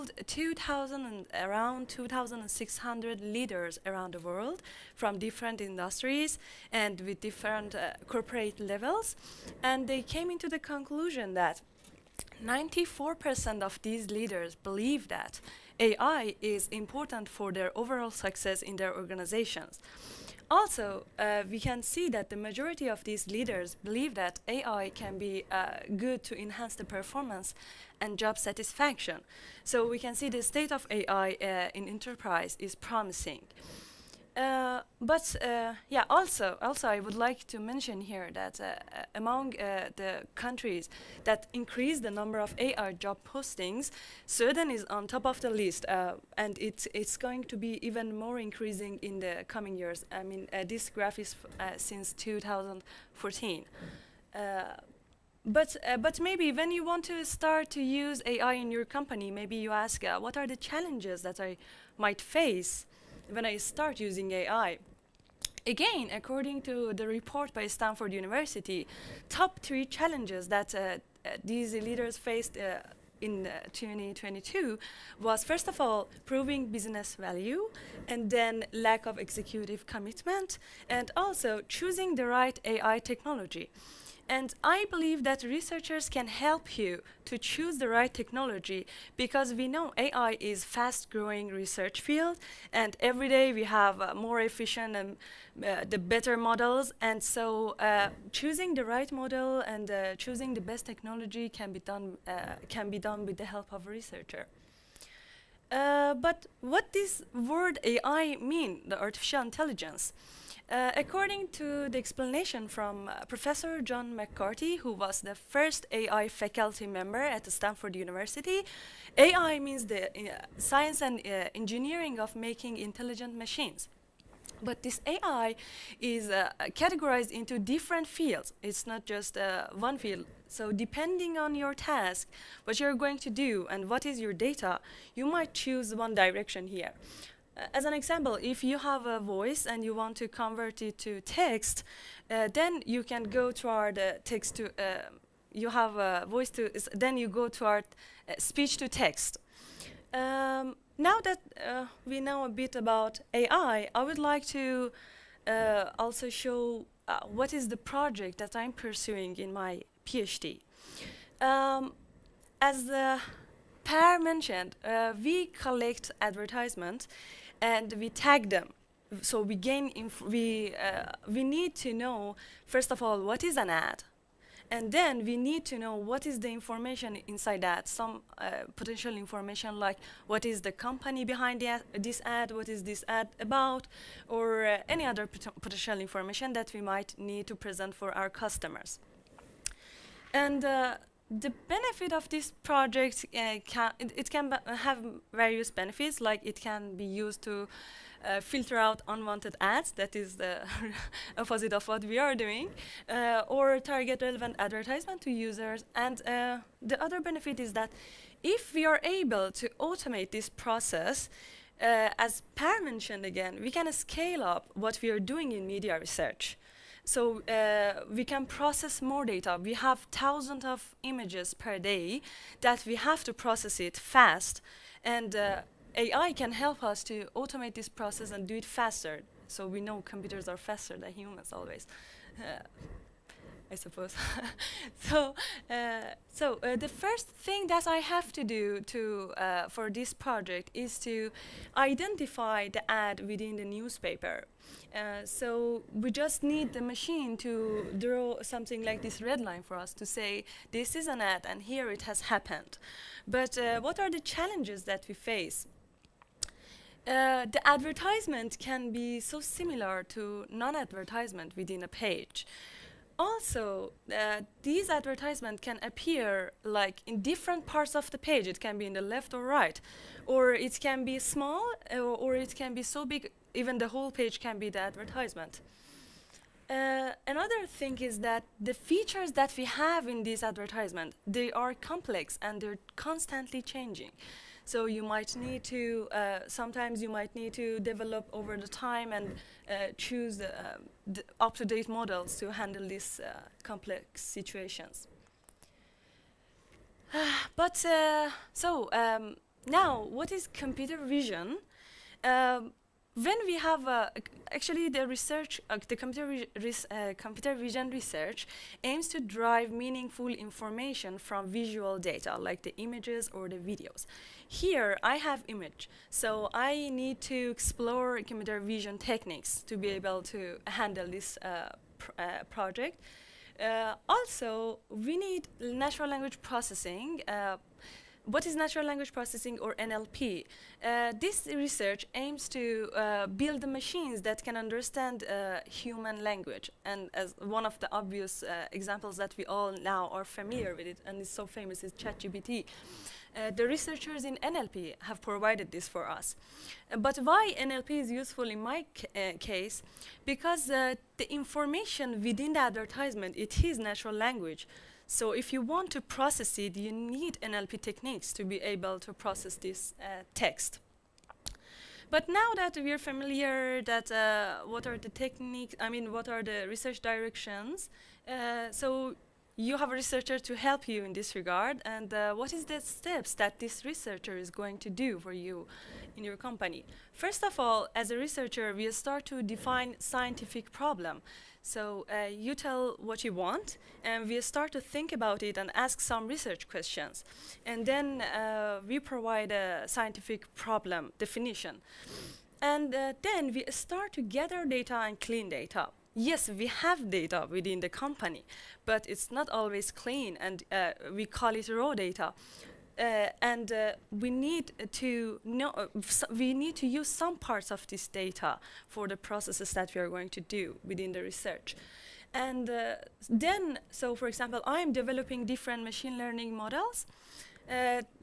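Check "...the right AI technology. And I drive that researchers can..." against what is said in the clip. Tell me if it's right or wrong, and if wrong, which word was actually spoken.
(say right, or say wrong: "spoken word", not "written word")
wrong: "believe", not "drive".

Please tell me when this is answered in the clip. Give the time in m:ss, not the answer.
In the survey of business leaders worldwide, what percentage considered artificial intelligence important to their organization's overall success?
0:12.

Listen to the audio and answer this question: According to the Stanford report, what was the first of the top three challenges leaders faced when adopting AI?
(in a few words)
Proving business value.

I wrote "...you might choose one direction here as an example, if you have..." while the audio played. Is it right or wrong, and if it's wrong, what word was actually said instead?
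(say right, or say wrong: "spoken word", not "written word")
right.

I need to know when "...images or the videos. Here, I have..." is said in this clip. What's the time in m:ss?
5:12.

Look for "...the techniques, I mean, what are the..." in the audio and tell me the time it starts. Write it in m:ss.
6:04.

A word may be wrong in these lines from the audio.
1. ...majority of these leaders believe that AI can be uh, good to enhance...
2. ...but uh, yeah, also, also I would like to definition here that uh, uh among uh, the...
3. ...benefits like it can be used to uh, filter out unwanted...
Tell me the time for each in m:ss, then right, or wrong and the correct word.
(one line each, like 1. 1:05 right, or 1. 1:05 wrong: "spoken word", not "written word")
1. 0:22 right
2. 0:35 wrong: "mention", not "definition"
3. 3:15 right.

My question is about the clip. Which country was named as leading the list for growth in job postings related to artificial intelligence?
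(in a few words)
Sweden.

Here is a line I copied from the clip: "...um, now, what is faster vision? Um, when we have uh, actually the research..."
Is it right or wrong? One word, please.
wrong.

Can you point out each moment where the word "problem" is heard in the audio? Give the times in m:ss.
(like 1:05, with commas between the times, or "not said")
6:20, 6:30.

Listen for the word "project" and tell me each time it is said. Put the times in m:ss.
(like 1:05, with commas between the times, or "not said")
2:37, 3:12, 4:00, 5:22.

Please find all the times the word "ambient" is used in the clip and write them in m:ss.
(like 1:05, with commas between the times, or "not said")
not said.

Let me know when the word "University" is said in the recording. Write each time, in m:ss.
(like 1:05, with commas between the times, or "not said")
1:08, 1:57.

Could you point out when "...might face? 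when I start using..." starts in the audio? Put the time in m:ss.
1:01.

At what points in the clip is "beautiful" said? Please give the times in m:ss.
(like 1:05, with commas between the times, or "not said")
not said.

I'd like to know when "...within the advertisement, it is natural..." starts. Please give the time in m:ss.
5:52.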